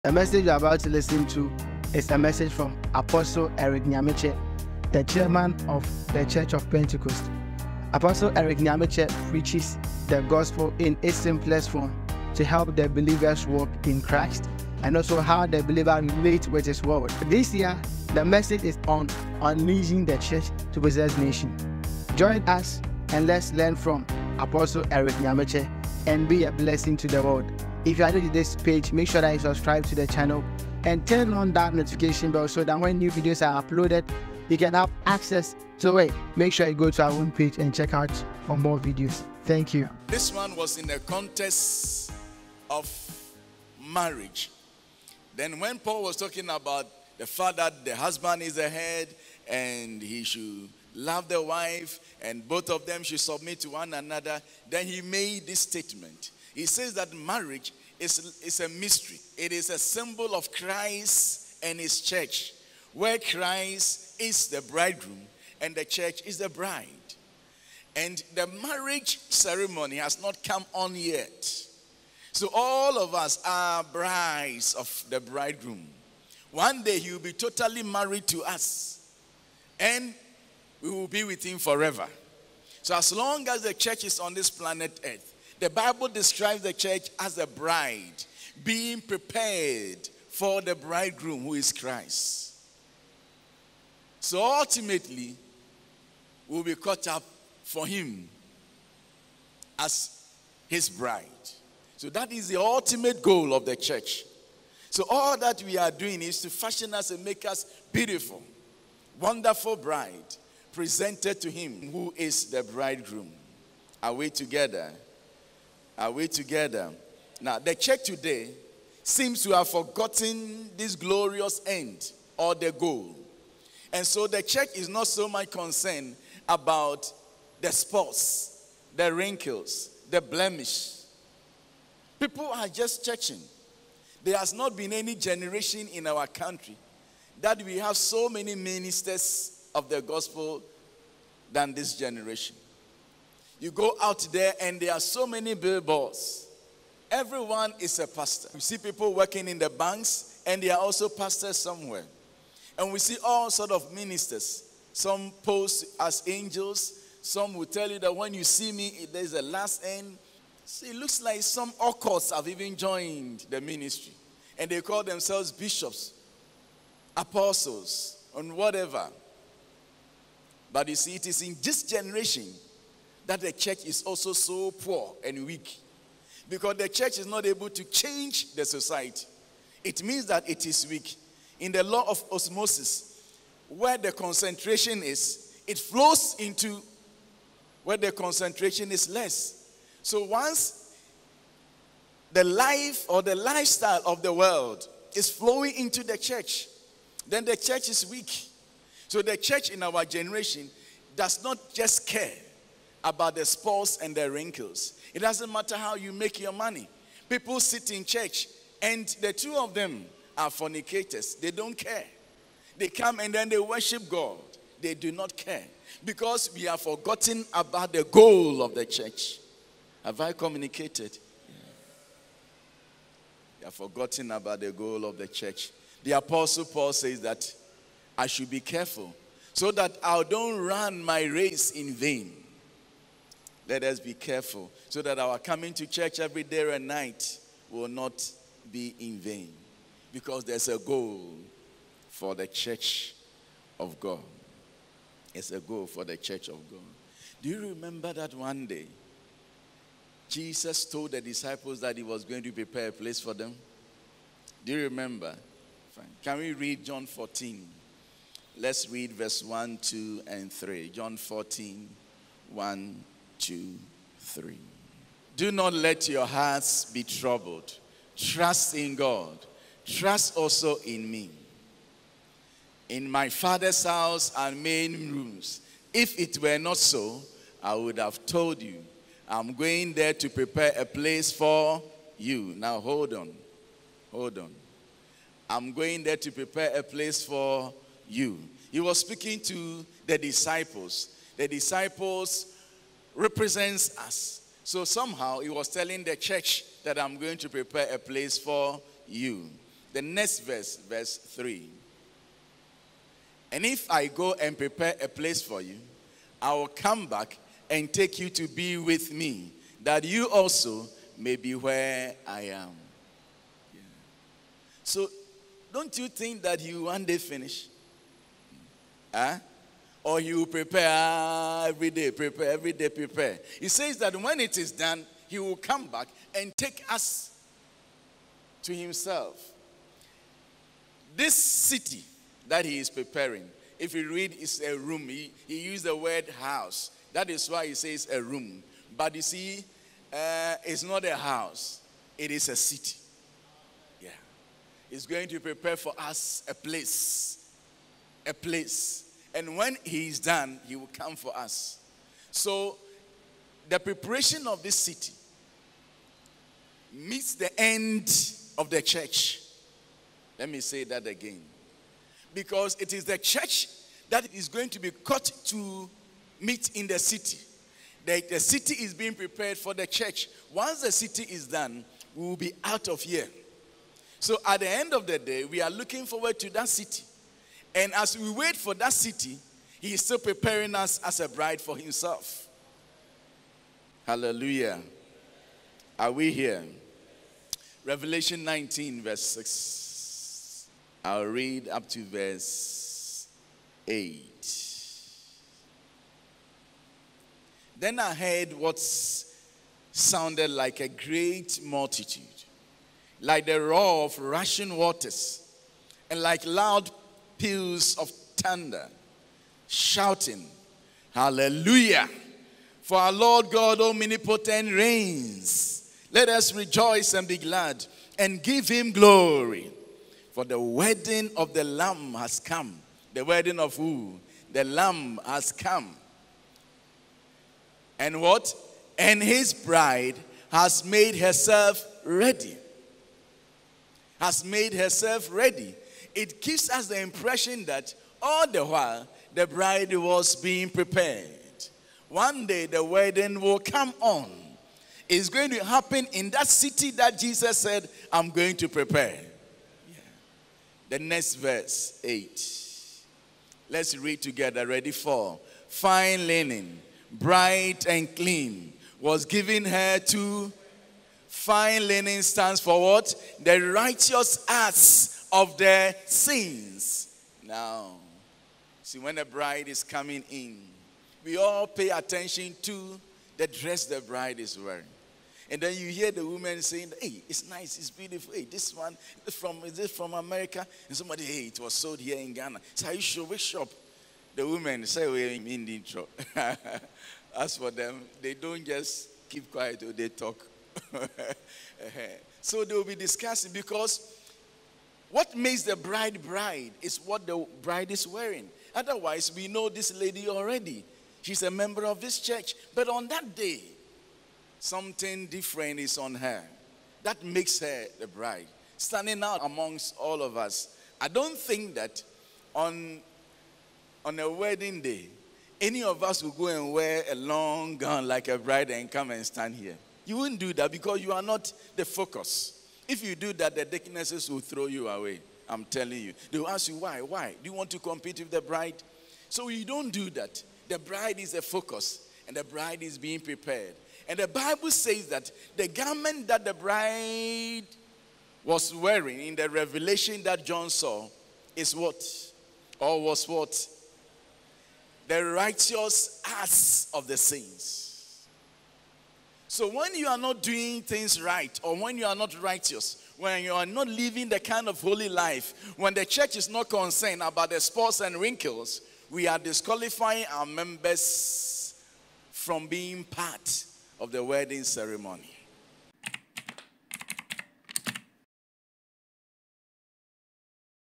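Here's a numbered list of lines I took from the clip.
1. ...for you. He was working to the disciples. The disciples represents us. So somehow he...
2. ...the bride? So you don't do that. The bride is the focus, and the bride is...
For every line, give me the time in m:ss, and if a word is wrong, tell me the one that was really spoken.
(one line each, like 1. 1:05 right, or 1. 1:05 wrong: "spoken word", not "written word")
1. 4:47 wrong: "speaking", not "working"
2. 8:48 right.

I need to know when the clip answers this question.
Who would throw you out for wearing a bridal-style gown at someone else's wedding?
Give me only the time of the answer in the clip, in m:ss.
8:43.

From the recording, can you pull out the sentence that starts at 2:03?
And so the church is not so much concerned about the spots, the wrinkles, the blemish.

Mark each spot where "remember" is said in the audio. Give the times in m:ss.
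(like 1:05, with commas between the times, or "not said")
4:07, 4:14.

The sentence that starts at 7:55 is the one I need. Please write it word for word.
And then you hear the woman saying, hey, it's nice, it's beautiful.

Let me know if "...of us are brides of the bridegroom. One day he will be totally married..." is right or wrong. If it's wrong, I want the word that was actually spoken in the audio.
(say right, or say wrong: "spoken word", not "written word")
right.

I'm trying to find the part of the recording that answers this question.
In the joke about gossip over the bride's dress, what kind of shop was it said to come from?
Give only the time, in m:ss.
8:05.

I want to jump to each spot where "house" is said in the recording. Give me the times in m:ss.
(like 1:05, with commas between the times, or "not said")
4:33, 5:36, 5:41.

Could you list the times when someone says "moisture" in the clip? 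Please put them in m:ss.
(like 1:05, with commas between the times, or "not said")
not said.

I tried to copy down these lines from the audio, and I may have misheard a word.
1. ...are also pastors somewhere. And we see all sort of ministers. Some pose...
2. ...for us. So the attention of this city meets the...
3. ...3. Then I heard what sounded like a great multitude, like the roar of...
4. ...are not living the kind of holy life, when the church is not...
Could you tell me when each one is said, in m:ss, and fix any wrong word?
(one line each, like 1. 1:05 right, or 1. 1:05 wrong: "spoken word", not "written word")
1. 2:30 right
2. 5:51 wrong: "preparation", not "attention"
3. 6:33 wrong: "8", not "3"
4. 9:13 right.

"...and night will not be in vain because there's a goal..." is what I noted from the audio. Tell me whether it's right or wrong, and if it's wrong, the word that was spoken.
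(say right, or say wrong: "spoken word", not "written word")
right.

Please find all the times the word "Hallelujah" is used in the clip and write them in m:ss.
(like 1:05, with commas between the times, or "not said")
6:24, 6:51.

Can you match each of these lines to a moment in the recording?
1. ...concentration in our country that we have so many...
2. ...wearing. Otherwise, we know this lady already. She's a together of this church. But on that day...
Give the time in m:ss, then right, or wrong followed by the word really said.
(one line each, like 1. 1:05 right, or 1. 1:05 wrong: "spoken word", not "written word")
1. 2:15 wrong: "generation", not "concentration"
2. 8:18 wrong: "member", not "together".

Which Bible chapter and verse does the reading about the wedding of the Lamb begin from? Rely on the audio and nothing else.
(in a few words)
Revelation 19:6.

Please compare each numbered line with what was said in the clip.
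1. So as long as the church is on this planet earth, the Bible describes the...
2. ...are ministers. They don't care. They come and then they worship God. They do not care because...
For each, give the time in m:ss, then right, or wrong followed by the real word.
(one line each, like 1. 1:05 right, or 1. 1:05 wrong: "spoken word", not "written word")
1. 1:22 right
2. 3:30 wrong: "fornicators", not "ministers".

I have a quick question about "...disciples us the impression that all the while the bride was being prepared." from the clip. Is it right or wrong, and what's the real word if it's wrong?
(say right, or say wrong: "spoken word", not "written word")
wrong: "gives", not "disciples".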